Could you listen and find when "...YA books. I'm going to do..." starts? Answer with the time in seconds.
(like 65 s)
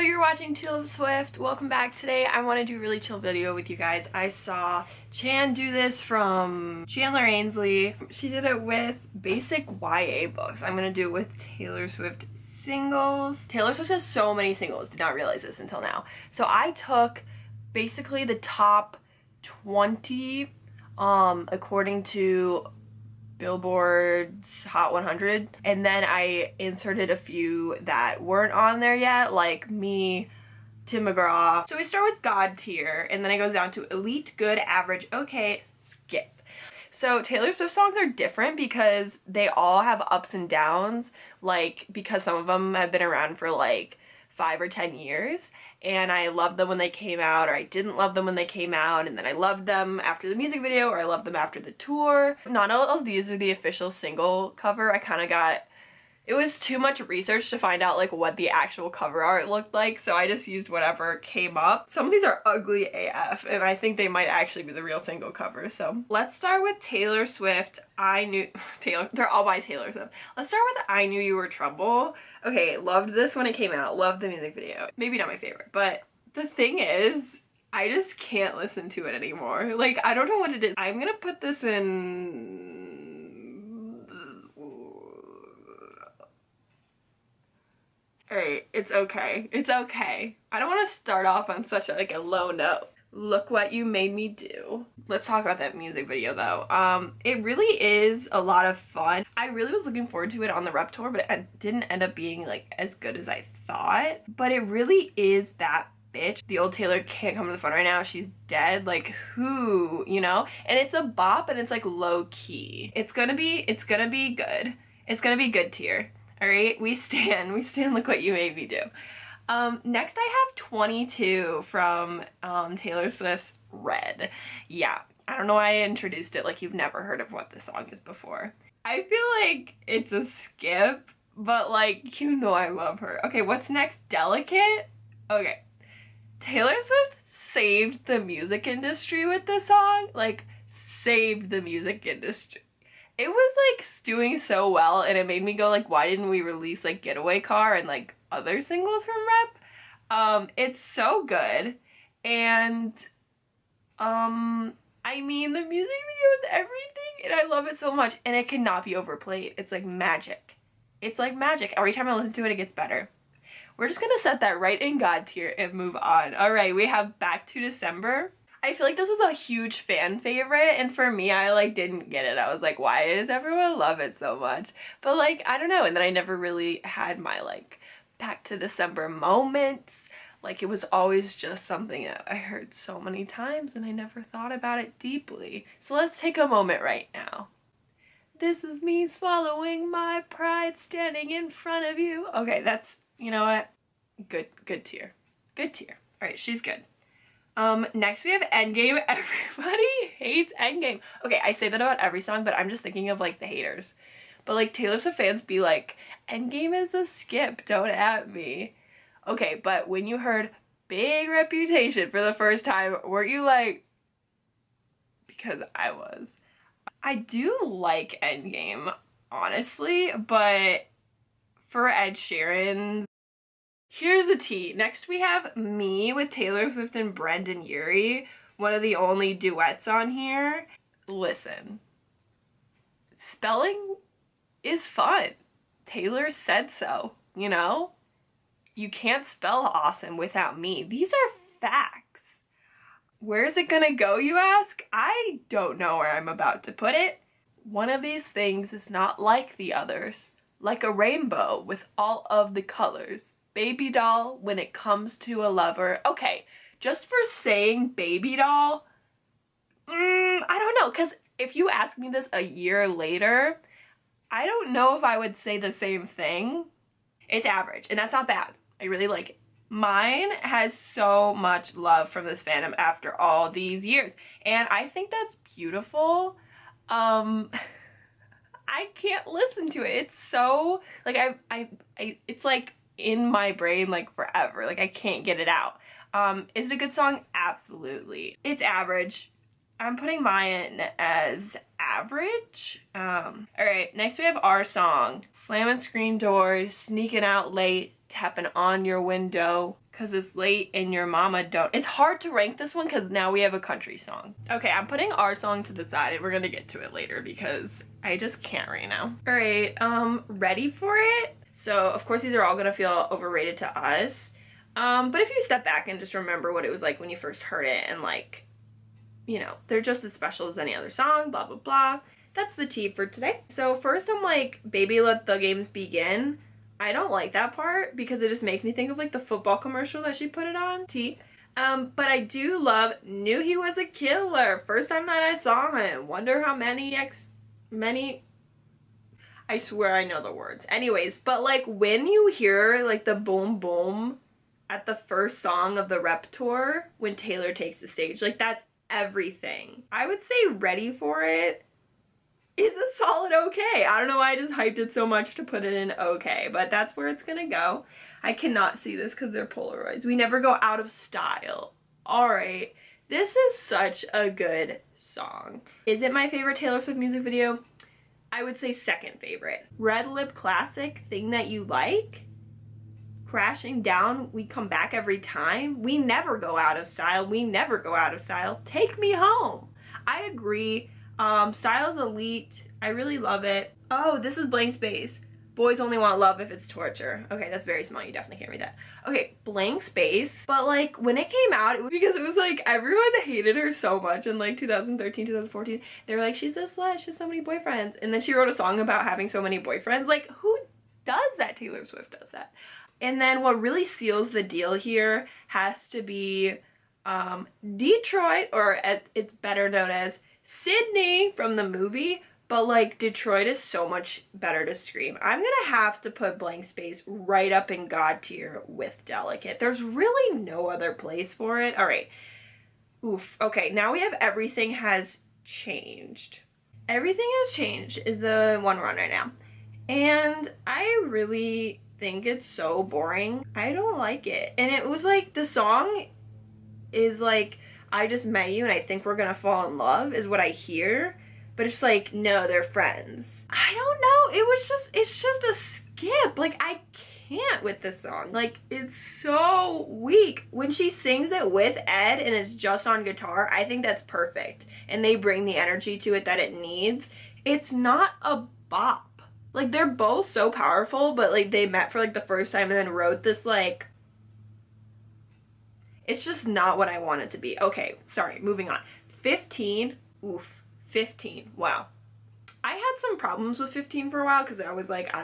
9 s.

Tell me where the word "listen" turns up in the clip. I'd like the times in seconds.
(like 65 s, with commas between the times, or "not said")
78 s, 162 s, 231 s, 279 s.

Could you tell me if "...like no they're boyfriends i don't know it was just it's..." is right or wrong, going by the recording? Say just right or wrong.
wrong.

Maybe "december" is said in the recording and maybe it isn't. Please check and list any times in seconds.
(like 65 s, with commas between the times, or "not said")
167 s, 178 s.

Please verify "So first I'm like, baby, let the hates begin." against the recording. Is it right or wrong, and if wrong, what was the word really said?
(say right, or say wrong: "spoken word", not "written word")
wrong: "games", not "hates".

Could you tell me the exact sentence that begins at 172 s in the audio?
I was like why does everyone love it so much?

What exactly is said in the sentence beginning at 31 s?
So we start with God tier and then it goes down to elite, good, average, okay, skip.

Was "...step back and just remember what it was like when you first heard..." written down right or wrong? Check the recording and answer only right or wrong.
right.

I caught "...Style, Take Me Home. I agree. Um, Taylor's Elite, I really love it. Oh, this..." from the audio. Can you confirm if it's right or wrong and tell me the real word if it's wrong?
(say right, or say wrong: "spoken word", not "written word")
wrong: "Style", not "Taylor".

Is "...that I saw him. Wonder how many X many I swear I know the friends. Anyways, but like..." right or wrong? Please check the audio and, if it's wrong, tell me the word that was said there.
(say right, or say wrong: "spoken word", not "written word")
wrong: "words", not "friends".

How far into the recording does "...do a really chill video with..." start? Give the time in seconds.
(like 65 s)
2 s.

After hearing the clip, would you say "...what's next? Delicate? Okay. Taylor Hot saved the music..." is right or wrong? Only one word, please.
wrong.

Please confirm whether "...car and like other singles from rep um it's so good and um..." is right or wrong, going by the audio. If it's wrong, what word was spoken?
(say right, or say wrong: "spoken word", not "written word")
right.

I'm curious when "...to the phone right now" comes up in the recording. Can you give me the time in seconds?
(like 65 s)
107 s.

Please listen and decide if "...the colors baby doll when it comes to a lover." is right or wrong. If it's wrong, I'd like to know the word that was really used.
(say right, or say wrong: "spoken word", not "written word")
right.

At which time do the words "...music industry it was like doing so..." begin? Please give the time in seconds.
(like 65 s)
141 s.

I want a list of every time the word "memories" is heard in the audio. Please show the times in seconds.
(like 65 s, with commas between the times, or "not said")
not said.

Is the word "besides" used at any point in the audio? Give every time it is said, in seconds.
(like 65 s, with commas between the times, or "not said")
not said.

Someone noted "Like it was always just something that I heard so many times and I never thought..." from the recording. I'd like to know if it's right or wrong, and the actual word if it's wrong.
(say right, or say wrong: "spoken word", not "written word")
right.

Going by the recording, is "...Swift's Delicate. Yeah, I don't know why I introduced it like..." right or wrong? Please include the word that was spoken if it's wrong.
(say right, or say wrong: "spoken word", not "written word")
wrong: "Red", not "Delicate".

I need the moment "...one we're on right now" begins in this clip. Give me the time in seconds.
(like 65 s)
428 s.